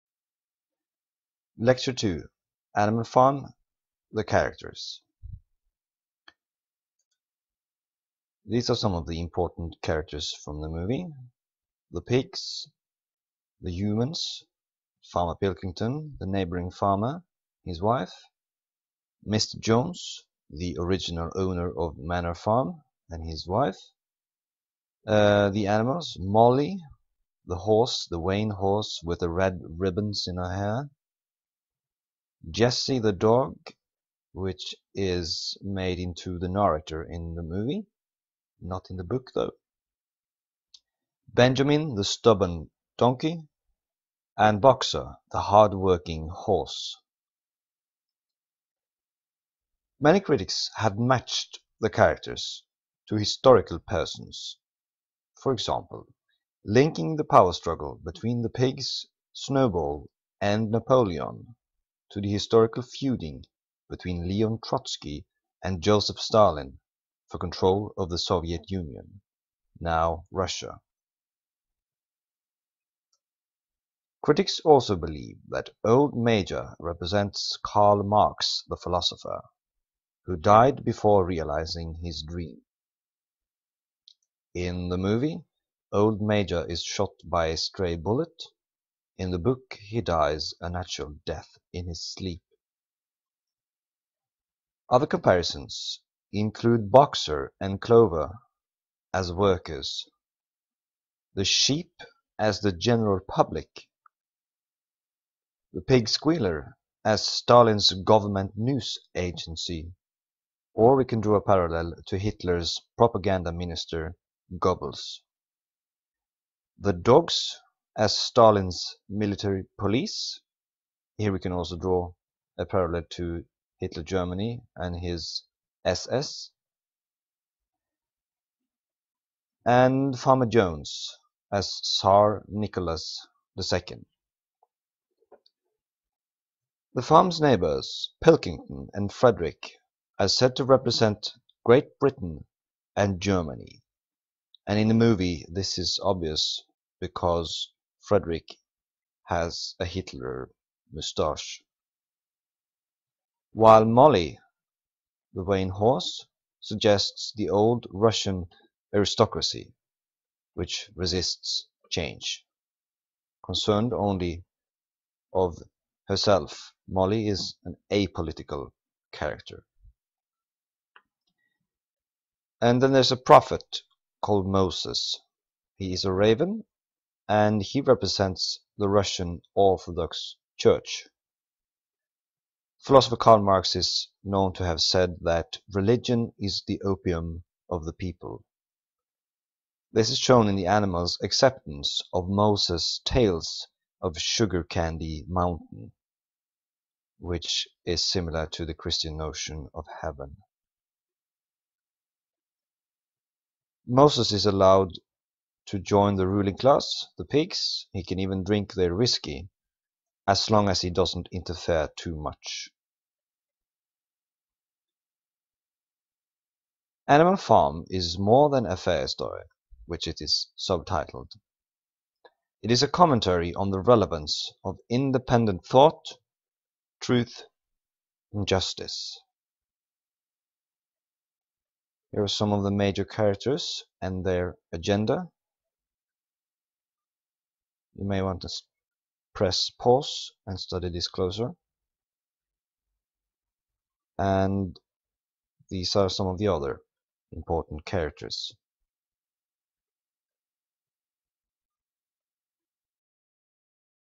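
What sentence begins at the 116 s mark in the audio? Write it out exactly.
The dogs as Stalin's military police.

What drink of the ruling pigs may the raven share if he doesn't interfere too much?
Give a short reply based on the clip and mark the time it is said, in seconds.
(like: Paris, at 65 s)
whiskey, at 208 s.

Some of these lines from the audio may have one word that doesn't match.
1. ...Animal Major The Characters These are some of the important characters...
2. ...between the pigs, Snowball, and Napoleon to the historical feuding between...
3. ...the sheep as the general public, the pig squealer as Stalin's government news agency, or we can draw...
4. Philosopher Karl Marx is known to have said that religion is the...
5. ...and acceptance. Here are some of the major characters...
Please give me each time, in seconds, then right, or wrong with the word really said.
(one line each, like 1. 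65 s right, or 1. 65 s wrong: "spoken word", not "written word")
1. 2 s wrong: "Farm", not "Major"
2. 58 s right
3. 101 s right
4. 182 s right
5. 228 s wrong: "justice", not "acceptance".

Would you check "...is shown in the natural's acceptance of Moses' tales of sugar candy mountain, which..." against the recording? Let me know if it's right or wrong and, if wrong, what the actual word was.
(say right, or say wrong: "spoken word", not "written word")
wrong: "animal", not "natural".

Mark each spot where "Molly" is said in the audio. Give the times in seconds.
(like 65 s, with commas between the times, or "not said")
26 s, 153 s, 166 s.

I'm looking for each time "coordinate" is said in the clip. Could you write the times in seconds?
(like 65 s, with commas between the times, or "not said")
not said.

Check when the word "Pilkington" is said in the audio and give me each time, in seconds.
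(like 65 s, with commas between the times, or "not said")
15 s, 138 s.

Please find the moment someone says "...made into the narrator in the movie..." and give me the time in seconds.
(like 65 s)
35 s.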